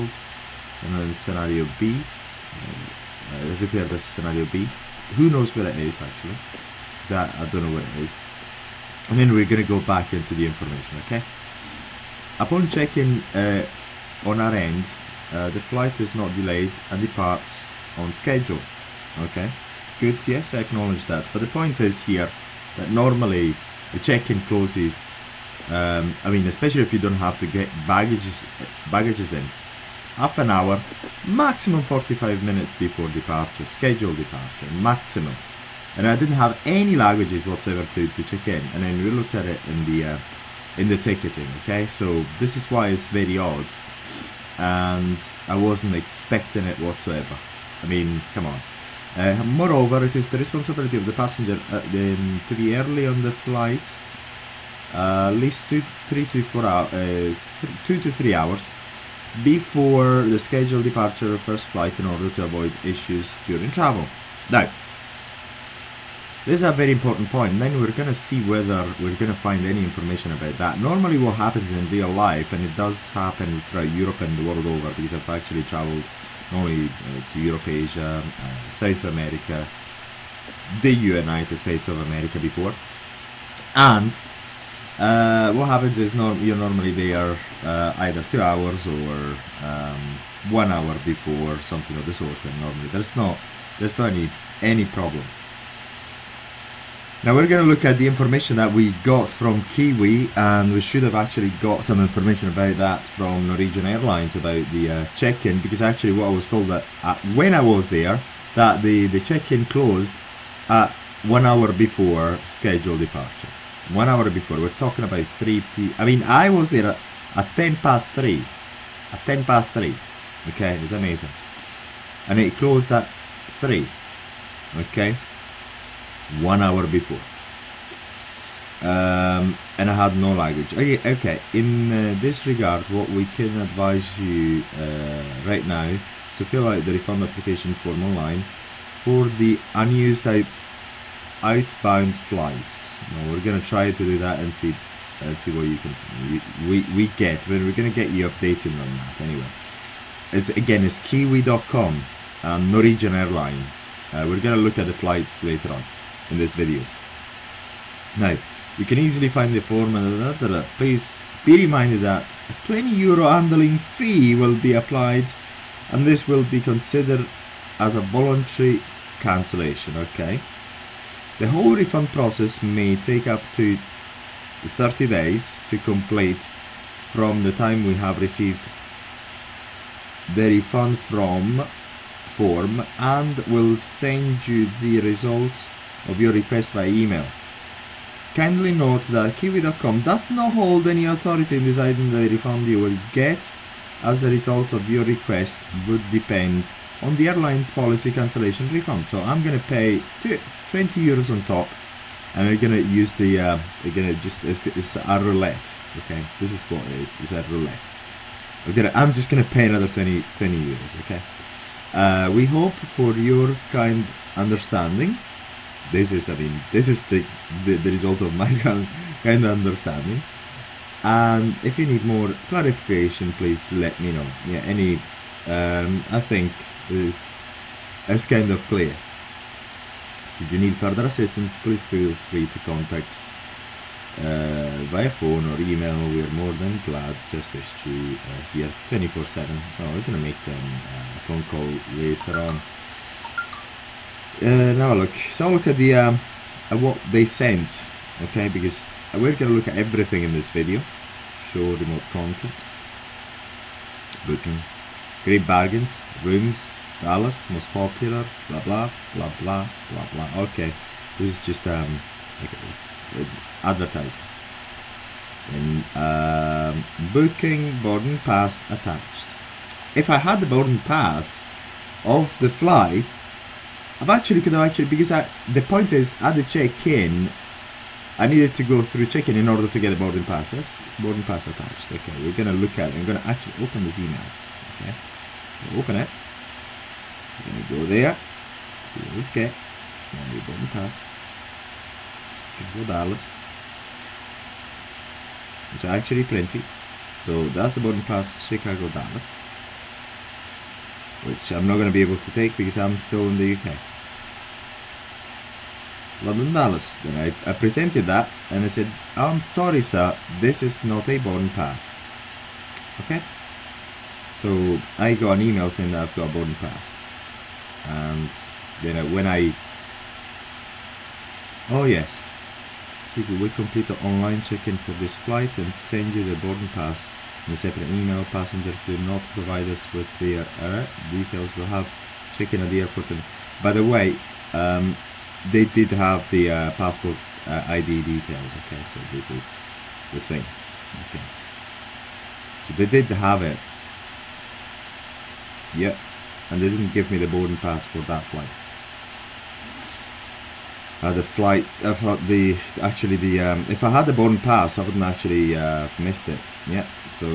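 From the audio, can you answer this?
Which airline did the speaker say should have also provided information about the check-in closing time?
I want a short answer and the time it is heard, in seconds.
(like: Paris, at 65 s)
Norwegian Airlines, at 103 s.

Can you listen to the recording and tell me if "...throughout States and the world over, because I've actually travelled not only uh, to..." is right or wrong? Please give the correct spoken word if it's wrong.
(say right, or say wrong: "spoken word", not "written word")
wrong: "Europe", not "States".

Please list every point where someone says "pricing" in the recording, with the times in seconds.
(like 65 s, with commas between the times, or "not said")
not said.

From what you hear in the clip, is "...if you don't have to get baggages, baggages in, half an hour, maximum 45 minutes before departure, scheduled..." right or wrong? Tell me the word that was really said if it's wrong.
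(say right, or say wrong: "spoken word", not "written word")
right.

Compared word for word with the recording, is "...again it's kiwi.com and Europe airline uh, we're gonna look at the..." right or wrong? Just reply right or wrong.
wrong.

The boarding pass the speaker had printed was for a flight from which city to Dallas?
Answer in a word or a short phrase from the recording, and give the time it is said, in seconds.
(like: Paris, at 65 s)
Chicago, at 298 s.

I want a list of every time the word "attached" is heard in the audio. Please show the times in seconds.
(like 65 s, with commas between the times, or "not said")
268 s, 281 s.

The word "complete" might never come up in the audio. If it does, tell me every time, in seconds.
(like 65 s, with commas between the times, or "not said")
175 s, 323 s.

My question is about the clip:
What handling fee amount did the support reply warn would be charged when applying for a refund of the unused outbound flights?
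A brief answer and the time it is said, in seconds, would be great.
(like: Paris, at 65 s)
20 euro, at 162 s.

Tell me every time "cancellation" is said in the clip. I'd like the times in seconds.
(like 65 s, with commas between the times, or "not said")
169 s, 198 s.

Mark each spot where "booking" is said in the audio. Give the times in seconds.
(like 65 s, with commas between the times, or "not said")
254 s, 267 s.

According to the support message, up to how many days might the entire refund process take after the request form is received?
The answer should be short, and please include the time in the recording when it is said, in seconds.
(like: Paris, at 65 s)
30 days, at 174 s.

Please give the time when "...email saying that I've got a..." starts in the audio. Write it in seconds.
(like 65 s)
315 s.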